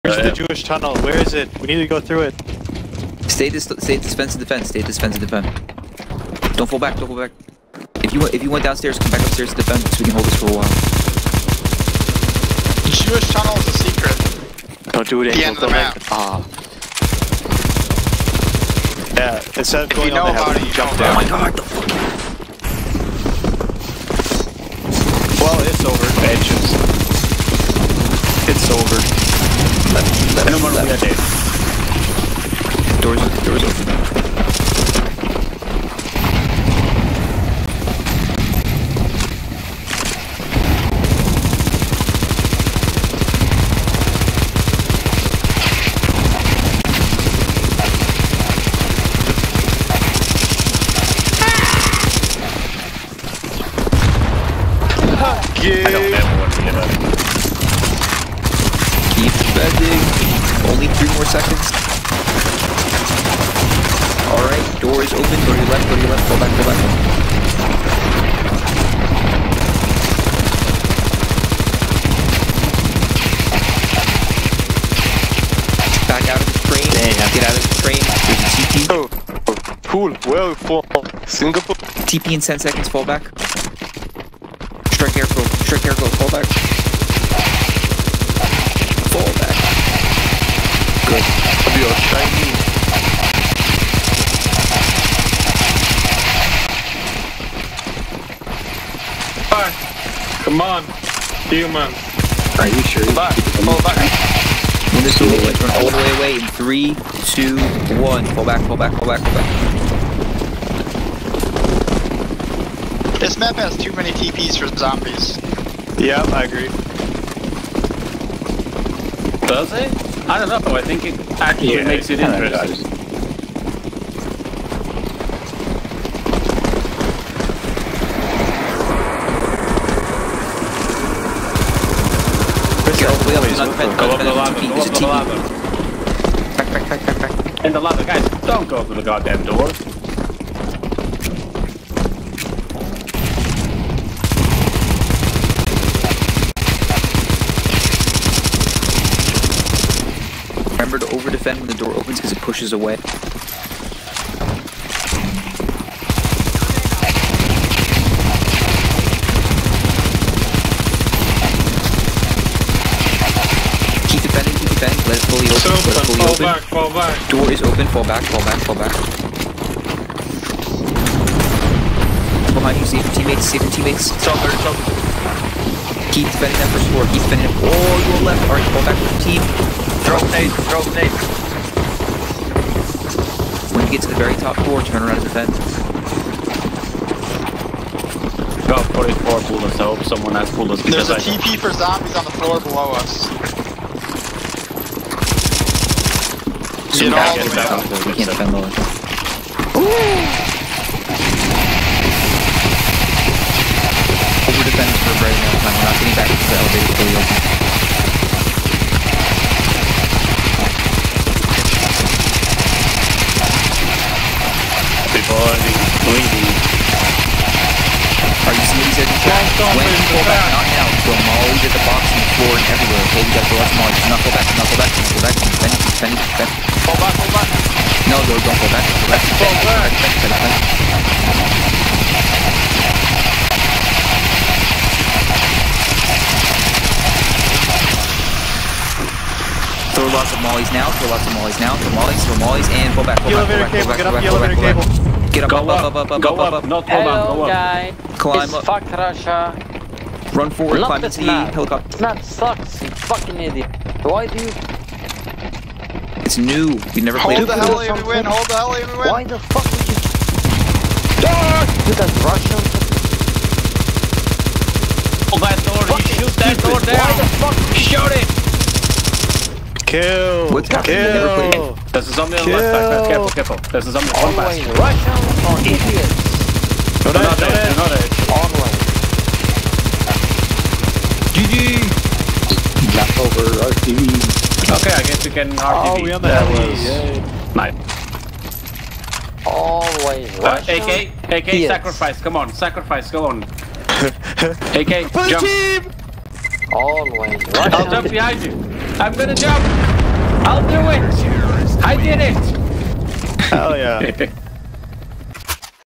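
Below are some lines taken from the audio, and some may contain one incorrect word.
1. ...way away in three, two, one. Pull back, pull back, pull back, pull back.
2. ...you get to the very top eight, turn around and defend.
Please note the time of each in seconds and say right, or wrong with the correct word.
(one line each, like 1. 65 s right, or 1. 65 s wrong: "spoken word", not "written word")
1. 105 s right
2. 183 s wrong: "four", not "eight".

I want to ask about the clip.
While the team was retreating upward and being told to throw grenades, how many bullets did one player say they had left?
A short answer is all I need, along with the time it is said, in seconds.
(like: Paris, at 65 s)
44, at 188 s.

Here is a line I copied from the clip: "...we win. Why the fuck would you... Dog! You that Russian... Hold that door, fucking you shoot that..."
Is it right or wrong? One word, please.
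right.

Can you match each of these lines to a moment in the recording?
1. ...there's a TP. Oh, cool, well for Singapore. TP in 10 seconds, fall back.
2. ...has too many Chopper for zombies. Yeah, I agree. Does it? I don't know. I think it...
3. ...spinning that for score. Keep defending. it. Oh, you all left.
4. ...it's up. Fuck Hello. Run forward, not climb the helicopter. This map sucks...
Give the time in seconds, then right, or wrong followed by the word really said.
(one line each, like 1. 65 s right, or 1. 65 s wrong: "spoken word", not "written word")
1. 78 s right
2. 113 s wrong: "TPs", not "Chopper"
3. 176 s wrong: "spinning", not "defending"
4. 248 s wrong: "Russia", not "Hello".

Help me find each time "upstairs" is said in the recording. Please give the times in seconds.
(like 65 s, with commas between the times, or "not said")
9 s.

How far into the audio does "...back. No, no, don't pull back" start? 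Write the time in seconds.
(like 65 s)
227 s.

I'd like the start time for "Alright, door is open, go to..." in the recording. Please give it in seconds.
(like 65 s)
64 s.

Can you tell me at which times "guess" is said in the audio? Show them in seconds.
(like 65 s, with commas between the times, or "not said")
285 s.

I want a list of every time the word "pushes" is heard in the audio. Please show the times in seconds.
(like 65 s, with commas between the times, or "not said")
152 s.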